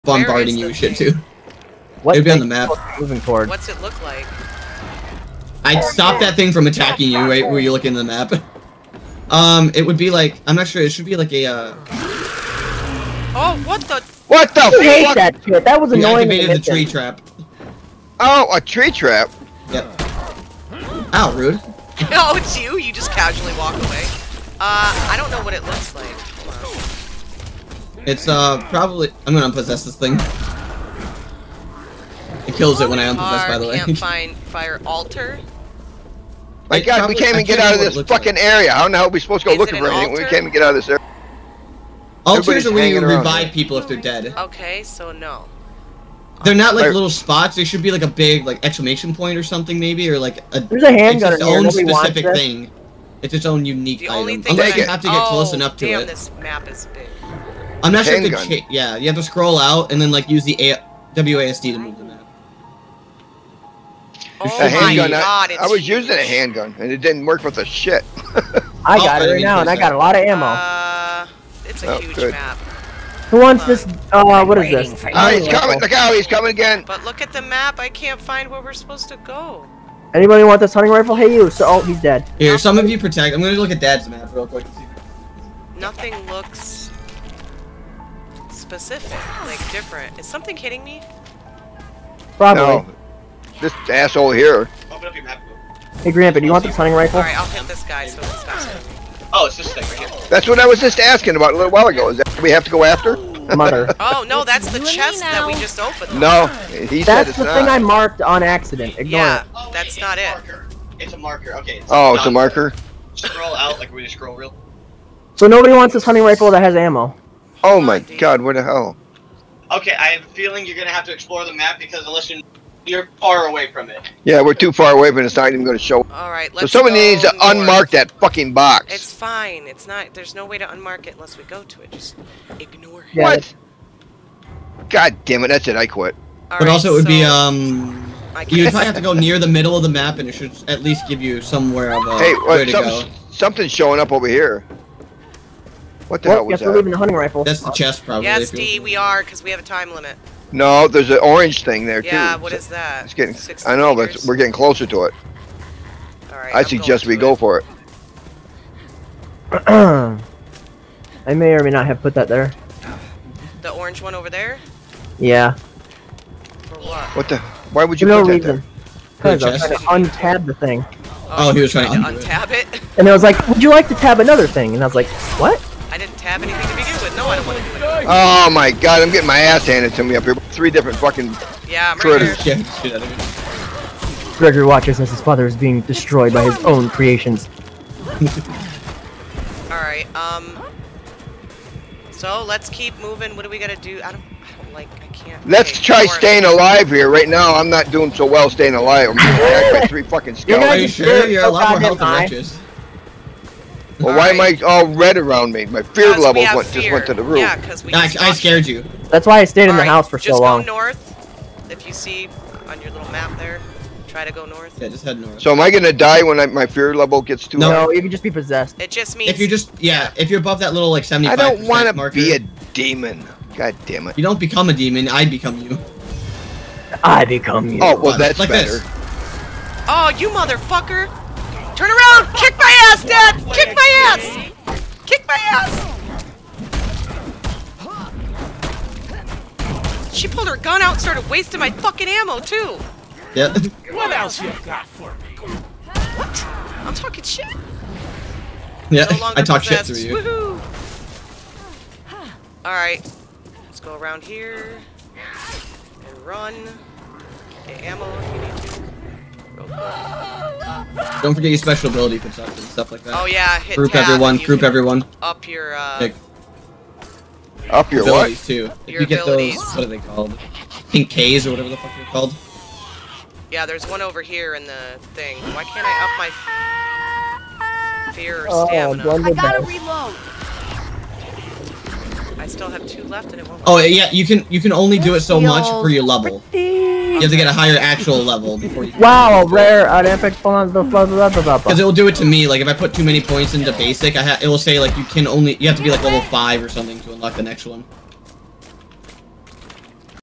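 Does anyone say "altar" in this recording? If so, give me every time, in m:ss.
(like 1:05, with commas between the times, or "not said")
0:34, 0:42.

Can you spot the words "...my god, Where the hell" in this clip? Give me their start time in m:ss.
1:57.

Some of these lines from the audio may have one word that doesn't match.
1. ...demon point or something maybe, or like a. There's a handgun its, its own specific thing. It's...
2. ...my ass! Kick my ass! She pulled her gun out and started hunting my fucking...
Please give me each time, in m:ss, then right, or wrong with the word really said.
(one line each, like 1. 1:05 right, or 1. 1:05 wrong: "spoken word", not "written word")
1. 0:48 wrong: "exclamation", not "demon"
2. 3:53 wrong: "wasting", not "hunting".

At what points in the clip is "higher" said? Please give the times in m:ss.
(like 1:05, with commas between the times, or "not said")
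4:47.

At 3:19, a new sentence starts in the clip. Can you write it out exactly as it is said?
I'm being attacked by three fucking skeletons.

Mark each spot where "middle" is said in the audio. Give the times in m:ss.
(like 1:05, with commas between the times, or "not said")
2:19.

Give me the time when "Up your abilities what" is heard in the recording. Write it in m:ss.
4:27.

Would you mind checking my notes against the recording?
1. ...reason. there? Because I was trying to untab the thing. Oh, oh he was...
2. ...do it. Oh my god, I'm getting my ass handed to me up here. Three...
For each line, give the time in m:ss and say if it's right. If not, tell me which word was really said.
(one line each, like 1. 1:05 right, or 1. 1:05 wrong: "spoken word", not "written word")
1. 2:48 right
2. 2:57 right.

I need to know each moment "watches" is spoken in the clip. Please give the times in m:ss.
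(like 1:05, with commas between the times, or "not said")
3:04.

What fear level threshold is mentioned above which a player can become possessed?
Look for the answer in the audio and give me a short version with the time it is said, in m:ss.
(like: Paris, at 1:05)
75, at 3:41.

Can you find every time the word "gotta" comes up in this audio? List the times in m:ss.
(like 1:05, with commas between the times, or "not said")
3:13, 4:39.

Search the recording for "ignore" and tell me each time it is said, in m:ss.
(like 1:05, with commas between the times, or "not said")
1:48, 2:12.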